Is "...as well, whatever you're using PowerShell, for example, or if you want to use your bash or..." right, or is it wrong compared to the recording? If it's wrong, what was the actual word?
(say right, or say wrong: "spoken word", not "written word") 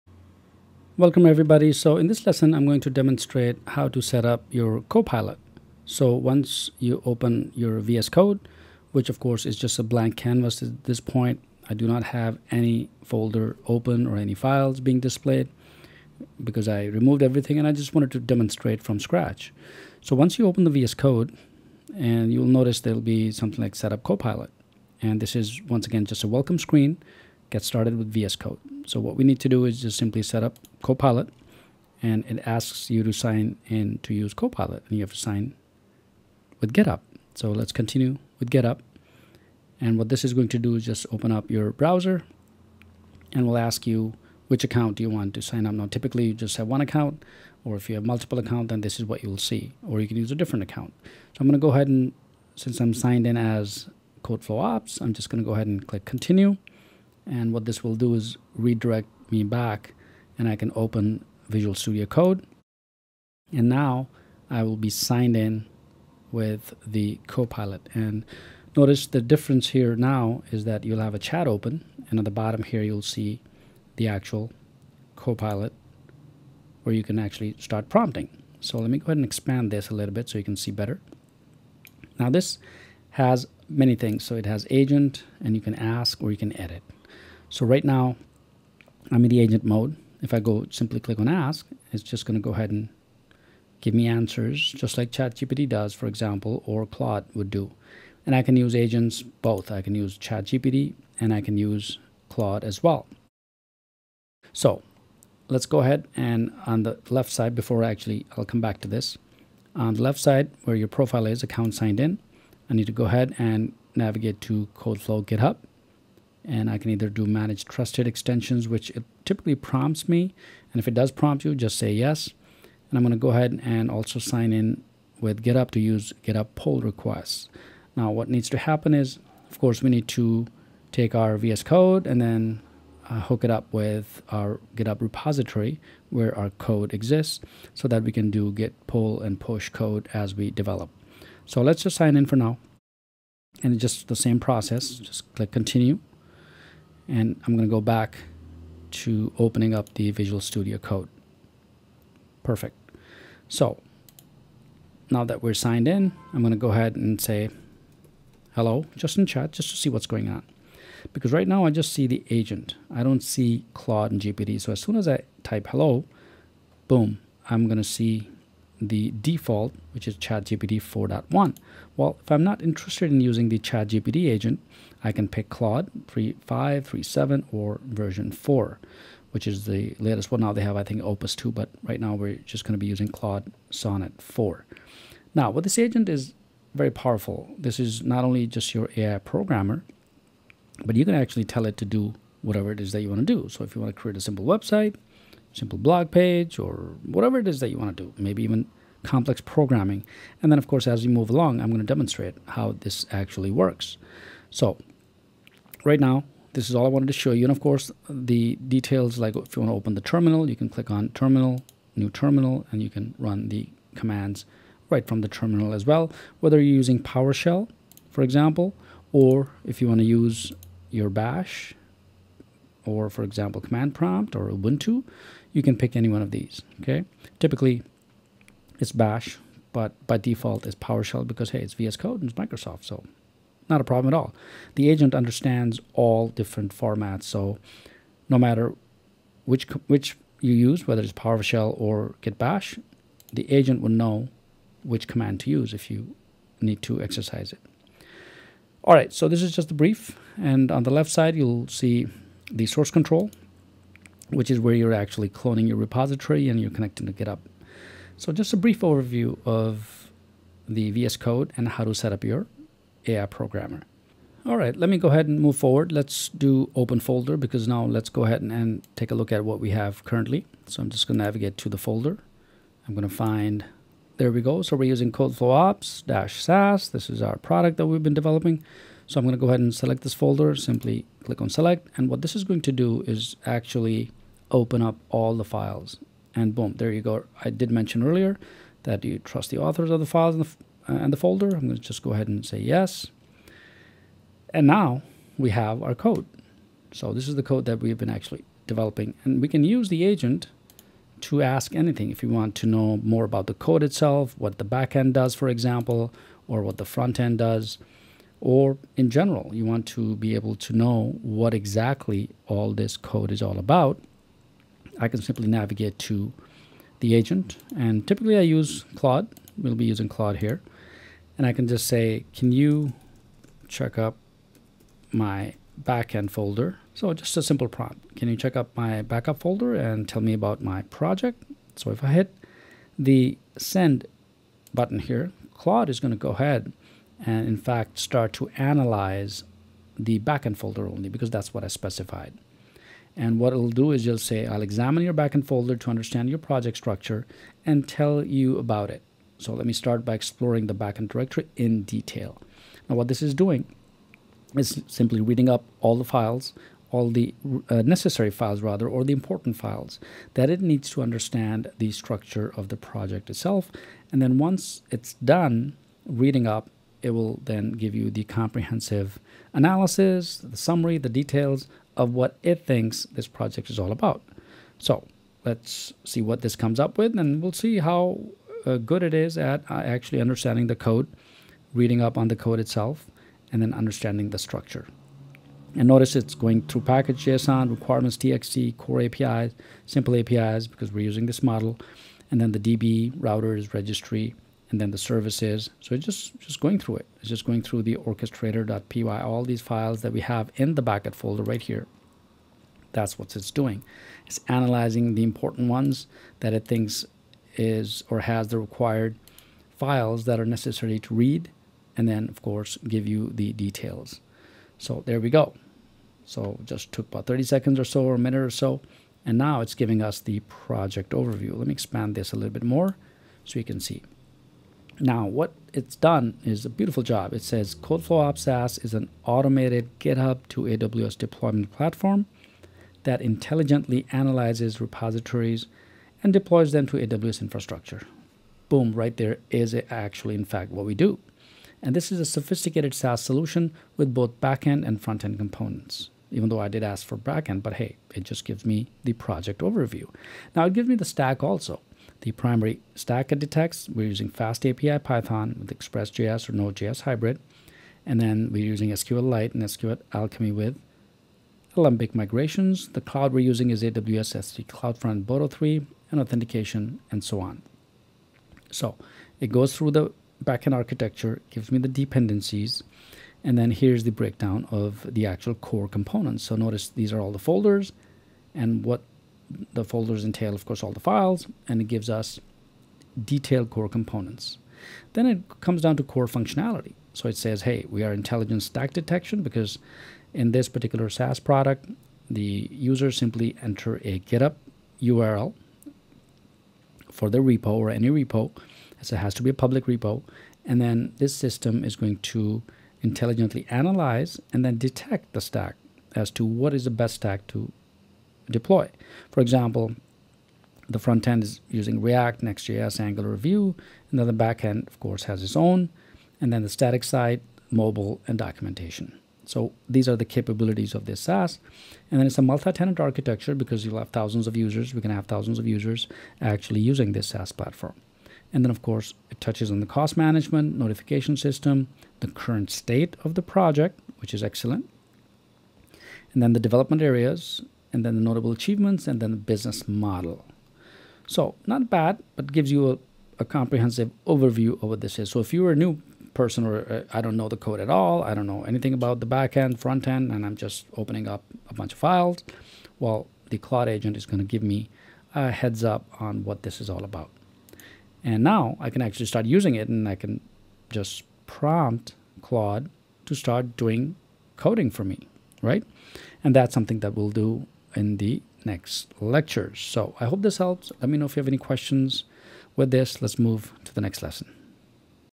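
wrong: "whether", not "whatever".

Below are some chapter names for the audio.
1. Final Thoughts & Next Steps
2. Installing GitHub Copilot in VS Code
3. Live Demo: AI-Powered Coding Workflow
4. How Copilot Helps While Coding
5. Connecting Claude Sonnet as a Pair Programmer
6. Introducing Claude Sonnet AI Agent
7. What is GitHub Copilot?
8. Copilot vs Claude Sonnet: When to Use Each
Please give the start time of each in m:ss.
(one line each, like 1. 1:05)
1. 9:30
2. 2:00
3. 8:30
4. 3:15
5. 5:45
6. 4:30
7. 0:45
8. 7:00.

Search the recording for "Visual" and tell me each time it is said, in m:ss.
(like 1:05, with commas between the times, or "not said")
1:01, 2:30.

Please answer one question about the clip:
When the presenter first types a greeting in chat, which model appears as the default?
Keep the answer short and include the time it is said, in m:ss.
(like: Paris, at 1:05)
ChatGPT 4.1, at 2:50.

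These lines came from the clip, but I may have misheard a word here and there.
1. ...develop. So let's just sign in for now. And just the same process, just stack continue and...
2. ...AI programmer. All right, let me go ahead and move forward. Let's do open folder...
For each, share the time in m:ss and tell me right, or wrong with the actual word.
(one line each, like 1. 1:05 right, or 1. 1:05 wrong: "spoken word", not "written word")
1. 2:20 wrong: "click", not "stack"
2. 4:23 right.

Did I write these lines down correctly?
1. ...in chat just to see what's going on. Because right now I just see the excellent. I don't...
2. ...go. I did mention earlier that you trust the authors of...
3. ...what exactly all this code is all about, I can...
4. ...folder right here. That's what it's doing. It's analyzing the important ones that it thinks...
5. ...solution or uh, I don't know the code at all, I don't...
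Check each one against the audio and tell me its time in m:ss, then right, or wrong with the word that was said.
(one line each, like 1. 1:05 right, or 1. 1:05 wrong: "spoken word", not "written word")
1. 2:39 wrong: "agent", not "excellent"
2. 4:47 right
3. 5:11 right
4. 6:41 right
5. 9:06 wrong: "person", not "solution".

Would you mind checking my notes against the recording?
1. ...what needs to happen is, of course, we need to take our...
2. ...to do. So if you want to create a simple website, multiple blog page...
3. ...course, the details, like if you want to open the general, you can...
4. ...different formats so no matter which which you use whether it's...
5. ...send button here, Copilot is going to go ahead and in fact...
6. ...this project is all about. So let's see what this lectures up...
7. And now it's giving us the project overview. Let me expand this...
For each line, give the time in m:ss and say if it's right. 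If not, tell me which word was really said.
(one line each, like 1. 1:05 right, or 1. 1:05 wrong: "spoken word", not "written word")
1. 2:08 right
2. 3:13 wrong: "simple", not "multiple"
3. 3:27 wrong: "terminal", not "general"
4. 3:56 right
5. 5:33 wrong: "Claude", not "Copilot"
6. 6:13 wrong: "comes", not "lectures"
7. 6:59 right.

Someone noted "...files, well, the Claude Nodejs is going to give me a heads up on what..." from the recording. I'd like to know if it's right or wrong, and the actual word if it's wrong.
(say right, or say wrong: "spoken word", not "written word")
wrong: "Agent", not "Nodejs".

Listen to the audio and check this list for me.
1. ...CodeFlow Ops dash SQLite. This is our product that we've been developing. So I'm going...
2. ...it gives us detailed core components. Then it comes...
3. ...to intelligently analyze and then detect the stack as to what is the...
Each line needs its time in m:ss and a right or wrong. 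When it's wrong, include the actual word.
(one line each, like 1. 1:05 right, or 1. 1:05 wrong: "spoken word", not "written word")
1. 4:35 wrong: "SAS", not "SQLite"
2. 8:01 right
3. 8:22 right.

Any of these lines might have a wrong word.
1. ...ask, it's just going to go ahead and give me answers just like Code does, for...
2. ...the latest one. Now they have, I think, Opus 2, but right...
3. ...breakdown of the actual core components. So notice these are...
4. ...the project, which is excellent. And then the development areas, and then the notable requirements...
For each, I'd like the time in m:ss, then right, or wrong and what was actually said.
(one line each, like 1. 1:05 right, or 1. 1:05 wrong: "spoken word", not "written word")
1. 1:31 wrong: "ChatGPT", not "Code"
2. 2:59 right
3. 7:54 right
4. 8:53 wrong: "achievements", not "requirements".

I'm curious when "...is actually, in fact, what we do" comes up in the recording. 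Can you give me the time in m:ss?
7:19.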